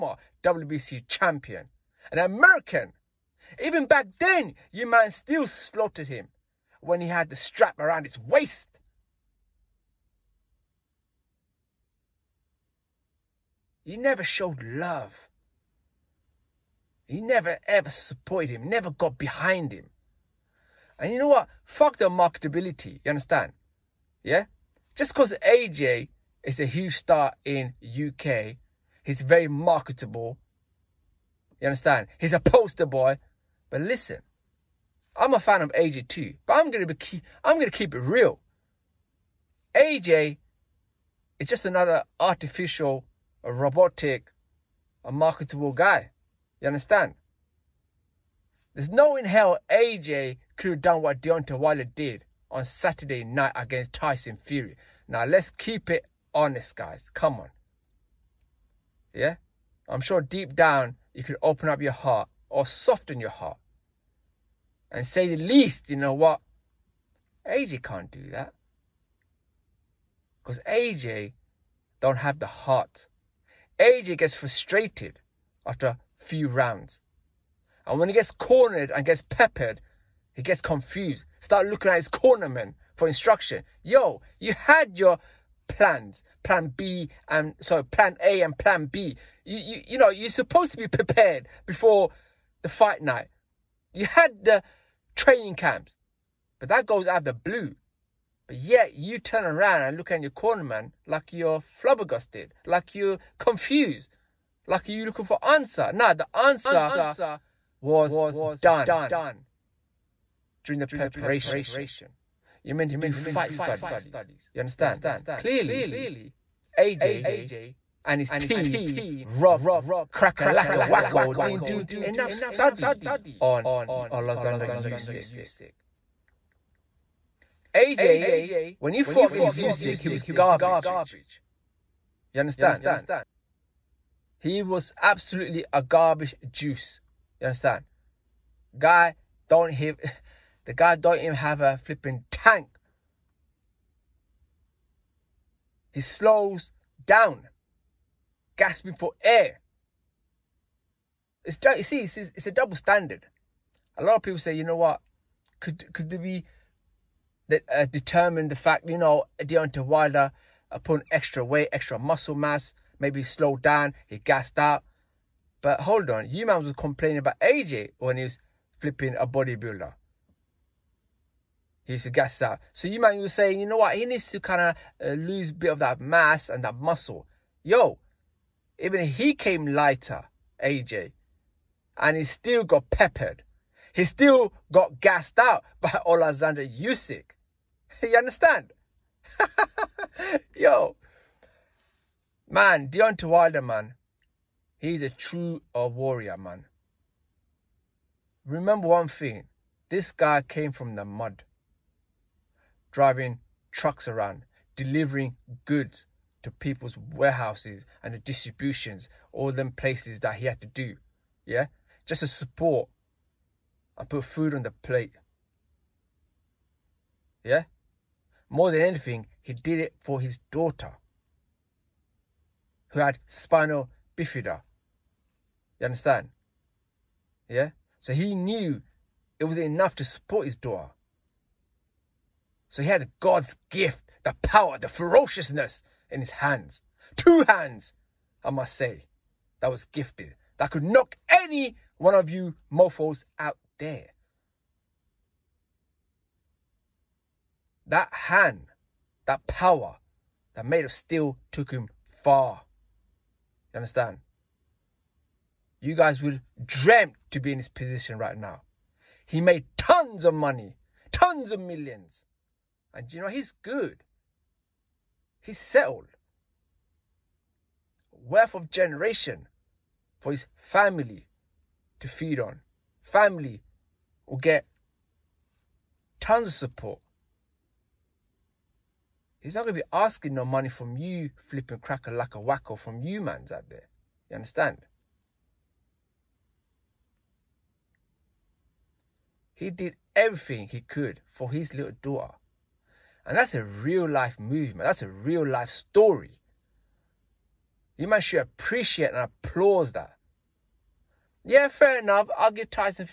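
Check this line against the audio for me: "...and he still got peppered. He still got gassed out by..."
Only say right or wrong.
right.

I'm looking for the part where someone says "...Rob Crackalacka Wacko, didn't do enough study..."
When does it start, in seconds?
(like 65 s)
119 s.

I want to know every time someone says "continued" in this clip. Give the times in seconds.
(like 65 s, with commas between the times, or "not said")
not said.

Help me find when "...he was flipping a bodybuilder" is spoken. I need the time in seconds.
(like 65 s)
168 s.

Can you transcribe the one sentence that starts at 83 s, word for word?
Yo, you had your plans, plan B and sorry, plan A and plan B.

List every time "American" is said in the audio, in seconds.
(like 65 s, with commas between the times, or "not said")
2 s.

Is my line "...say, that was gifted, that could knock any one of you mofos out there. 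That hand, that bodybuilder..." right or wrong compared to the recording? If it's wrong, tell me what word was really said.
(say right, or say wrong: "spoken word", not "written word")
wrong: "power", not "bodybuilder".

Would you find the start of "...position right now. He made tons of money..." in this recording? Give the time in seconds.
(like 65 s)
257 s.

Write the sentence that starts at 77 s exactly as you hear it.
And when he gets cornered and gets peppered, he gets confused.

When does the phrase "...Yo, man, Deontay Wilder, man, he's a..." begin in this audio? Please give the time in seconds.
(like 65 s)
190 s.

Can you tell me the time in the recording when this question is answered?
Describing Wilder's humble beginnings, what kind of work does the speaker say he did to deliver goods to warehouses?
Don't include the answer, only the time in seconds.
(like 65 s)
202 s.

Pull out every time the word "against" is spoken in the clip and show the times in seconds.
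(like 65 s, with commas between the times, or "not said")
53 s, 129 s.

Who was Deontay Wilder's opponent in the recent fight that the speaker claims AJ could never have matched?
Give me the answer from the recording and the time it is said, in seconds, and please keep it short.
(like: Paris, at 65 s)
Tyson Fury, at 53 s.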